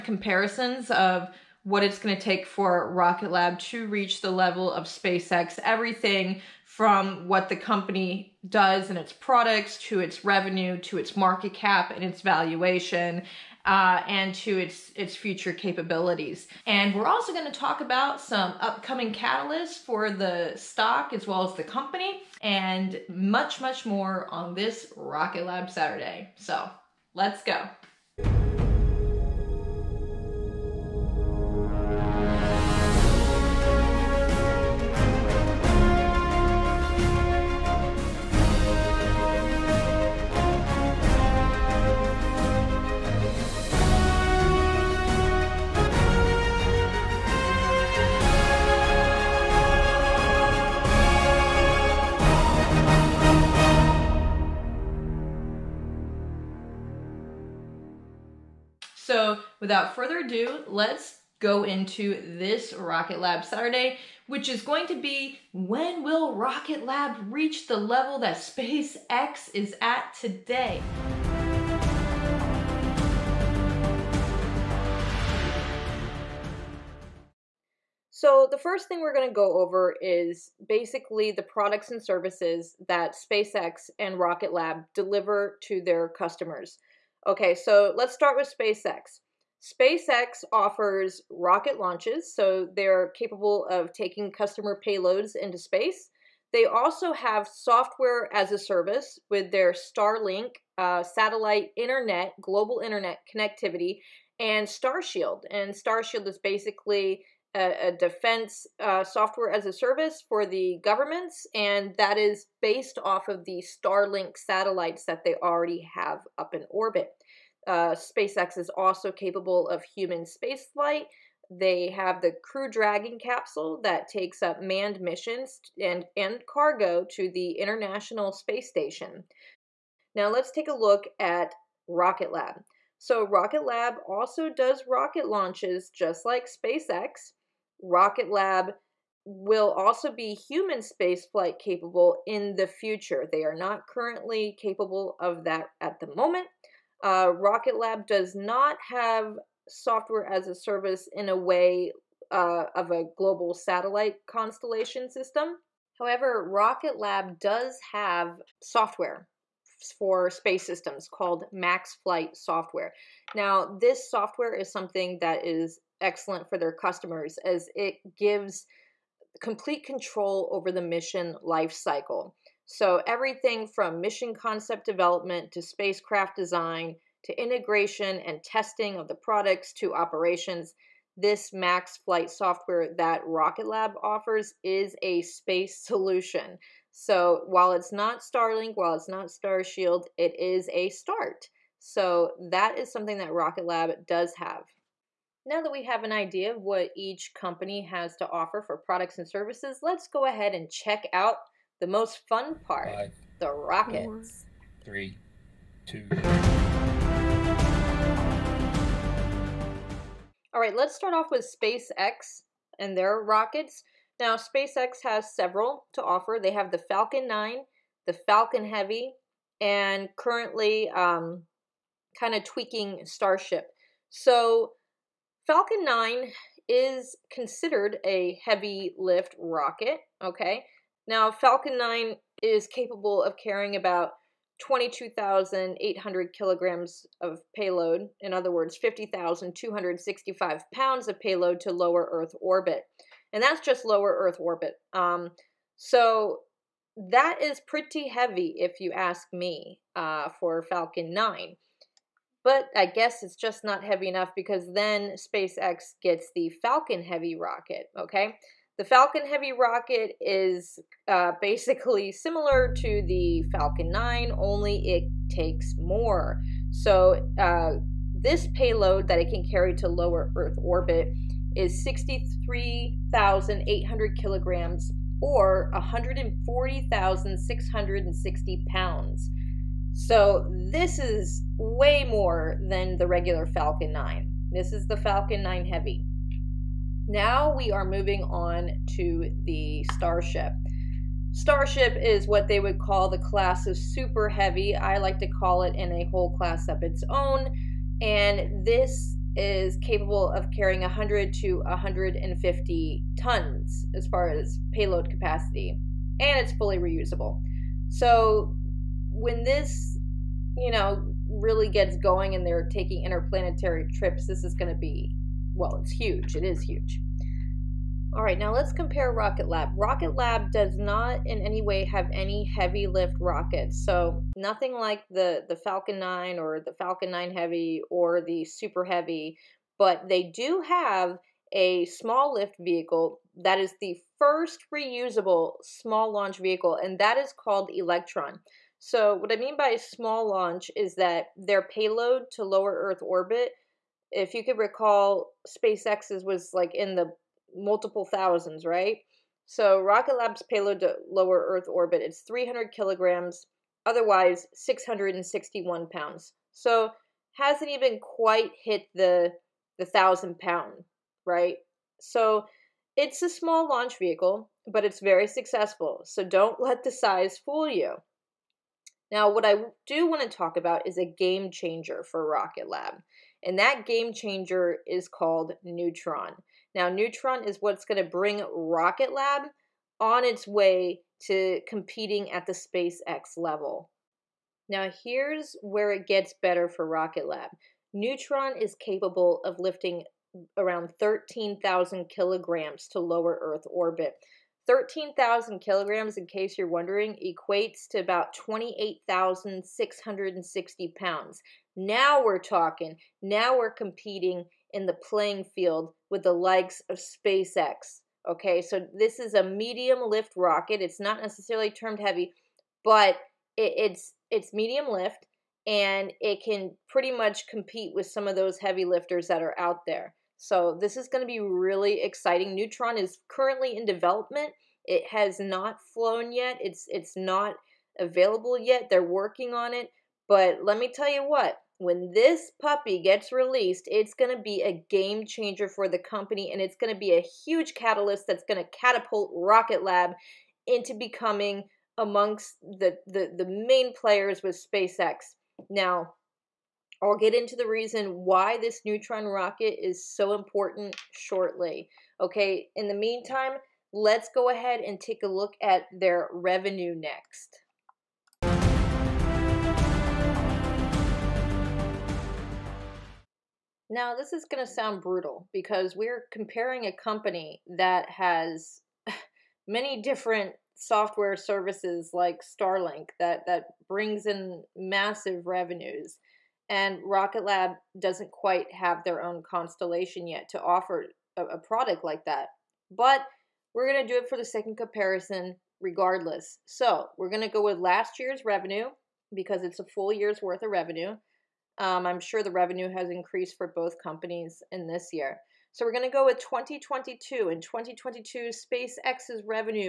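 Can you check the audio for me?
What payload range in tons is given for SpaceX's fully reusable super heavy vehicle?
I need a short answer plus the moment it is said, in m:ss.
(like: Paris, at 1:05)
100 to 150 tons, at 5:00.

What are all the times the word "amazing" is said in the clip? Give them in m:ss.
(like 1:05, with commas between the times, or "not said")
not said.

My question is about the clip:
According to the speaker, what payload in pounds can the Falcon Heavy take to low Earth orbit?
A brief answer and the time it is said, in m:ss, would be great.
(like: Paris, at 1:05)
140,660 pounds, at 4:35.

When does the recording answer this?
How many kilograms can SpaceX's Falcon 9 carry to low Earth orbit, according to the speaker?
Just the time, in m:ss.
3:54.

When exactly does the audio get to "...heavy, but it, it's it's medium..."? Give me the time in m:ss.
6:51.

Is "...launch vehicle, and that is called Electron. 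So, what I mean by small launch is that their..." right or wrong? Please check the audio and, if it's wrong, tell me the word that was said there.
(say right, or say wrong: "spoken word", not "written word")
right.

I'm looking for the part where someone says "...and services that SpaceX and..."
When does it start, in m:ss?
1:21.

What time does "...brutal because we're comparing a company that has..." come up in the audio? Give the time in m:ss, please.
7:45.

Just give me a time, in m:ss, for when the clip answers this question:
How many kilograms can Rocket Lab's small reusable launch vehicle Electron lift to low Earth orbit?
5:52.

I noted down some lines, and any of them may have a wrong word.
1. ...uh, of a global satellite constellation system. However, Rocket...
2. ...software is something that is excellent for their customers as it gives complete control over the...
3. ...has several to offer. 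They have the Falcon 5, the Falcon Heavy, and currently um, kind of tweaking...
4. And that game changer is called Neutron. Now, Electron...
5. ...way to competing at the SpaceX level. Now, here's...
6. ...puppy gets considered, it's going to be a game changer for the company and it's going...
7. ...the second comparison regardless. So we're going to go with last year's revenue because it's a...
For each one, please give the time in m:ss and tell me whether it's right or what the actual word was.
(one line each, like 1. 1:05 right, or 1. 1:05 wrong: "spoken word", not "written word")
1. 2:32 right
2. 2:44 right
3. 3:35 wrong: "9", not "5"
4. 6:13 wrong: "Neutron", not "Electron"
5. 6:20 right
6. 7:12 wrong: "released", not "considered"
7. 8:04 right.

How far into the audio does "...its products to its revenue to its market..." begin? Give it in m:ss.
0:08.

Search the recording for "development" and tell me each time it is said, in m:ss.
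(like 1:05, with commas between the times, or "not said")
2:54, 7:03.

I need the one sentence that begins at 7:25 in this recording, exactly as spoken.
Now, I'll get into the reason why this neutron rocket is so important shortly.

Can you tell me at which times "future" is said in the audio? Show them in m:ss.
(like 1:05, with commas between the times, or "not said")
0:15, 2:22.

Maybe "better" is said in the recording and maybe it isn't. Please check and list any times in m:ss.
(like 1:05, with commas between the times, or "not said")
6:26.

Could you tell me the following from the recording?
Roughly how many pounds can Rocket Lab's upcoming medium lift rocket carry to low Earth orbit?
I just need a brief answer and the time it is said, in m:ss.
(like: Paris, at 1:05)
28,660 pounds, at 6:38.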